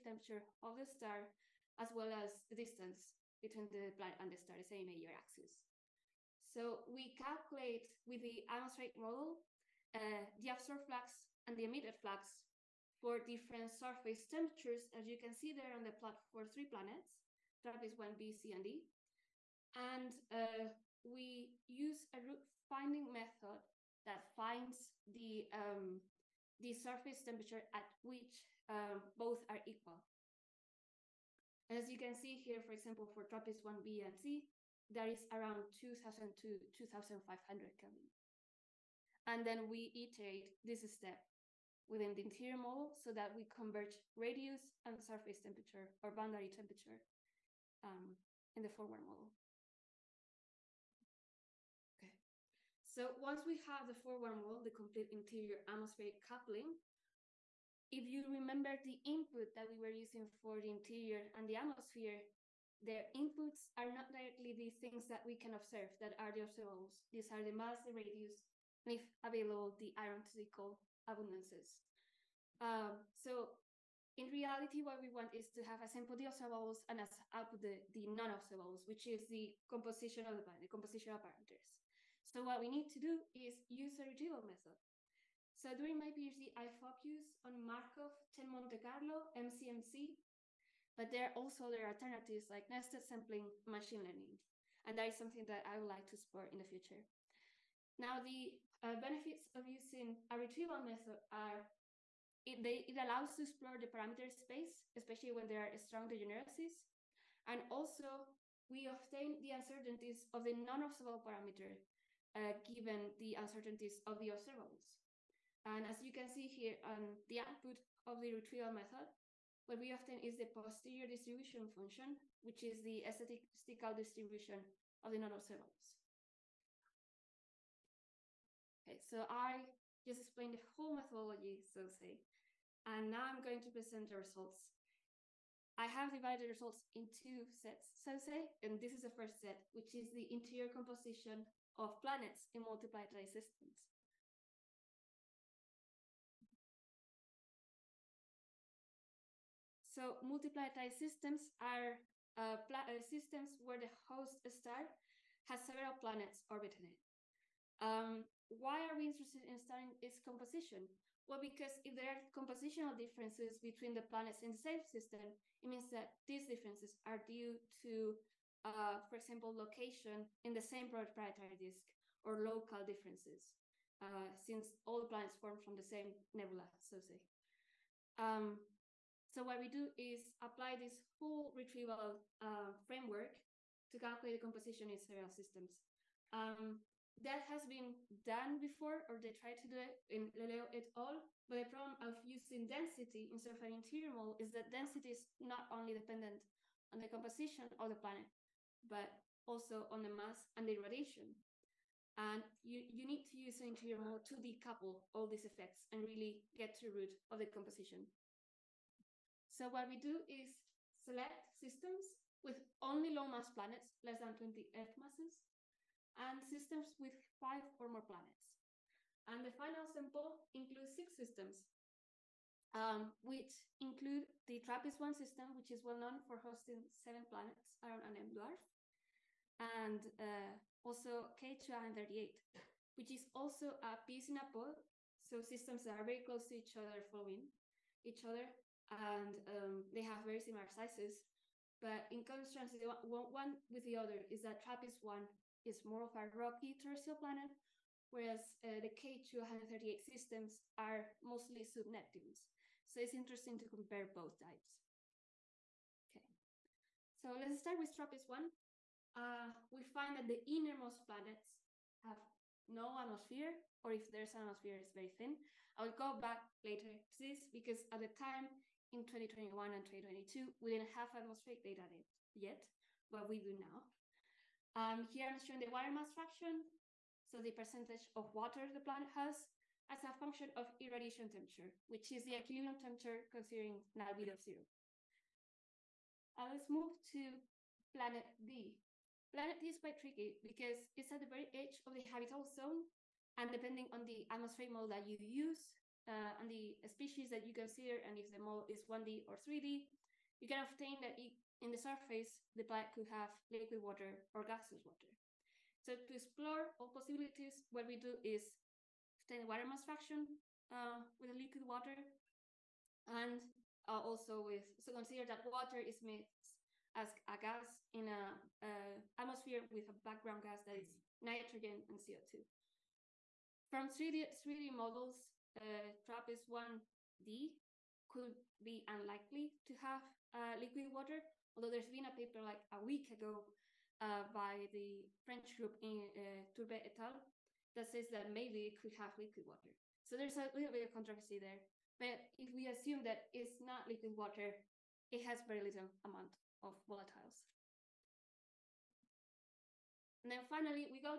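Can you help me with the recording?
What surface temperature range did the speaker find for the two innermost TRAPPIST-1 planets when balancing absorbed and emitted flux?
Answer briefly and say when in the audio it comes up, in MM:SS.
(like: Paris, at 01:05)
2000 to 2500 Kelvin, at 00:35.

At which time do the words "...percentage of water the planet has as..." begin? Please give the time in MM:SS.
04:37.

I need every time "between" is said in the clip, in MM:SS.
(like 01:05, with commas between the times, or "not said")
00:03, 02:43.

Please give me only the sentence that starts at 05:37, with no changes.
that says that maybe it could have liquid water.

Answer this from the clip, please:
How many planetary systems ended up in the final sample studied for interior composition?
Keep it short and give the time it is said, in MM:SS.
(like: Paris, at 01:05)
6, at 03:40.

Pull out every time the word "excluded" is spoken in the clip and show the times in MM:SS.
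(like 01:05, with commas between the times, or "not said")
not said.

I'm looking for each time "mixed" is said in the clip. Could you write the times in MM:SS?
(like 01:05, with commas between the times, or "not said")
05:16.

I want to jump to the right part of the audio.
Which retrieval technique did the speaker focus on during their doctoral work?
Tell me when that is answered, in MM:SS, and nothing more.
01:27.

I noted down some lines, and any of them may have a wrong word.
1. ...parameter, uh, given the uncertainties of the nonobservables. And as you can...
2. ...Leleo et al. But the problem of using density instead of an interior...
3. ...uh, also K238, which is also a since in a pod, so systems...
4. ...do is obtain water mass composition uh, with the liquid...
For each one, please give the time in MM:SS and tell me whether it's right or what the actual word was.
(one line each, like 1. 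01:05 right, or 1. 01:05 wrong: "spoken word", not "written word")
1. 01:51 wrong: "observables", not "nonobservables"
2. 03:10 right
3. 03:50 wrong: "piece", not "since"
4. 05:07 wrong: "fraction", not "composition".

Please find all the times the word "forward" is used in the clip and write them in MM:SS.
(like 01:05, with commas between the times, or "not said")
00:48, 00:53.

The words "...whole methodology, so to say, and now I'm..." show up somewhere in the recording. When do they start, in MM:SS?
02:10.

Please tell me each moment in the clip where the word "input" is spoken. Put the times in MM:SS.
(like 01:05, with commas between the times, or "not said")
00:59, 01:03.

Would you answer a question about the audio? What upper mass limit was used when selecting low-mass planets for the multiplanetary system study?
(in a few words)
20 Earth masses.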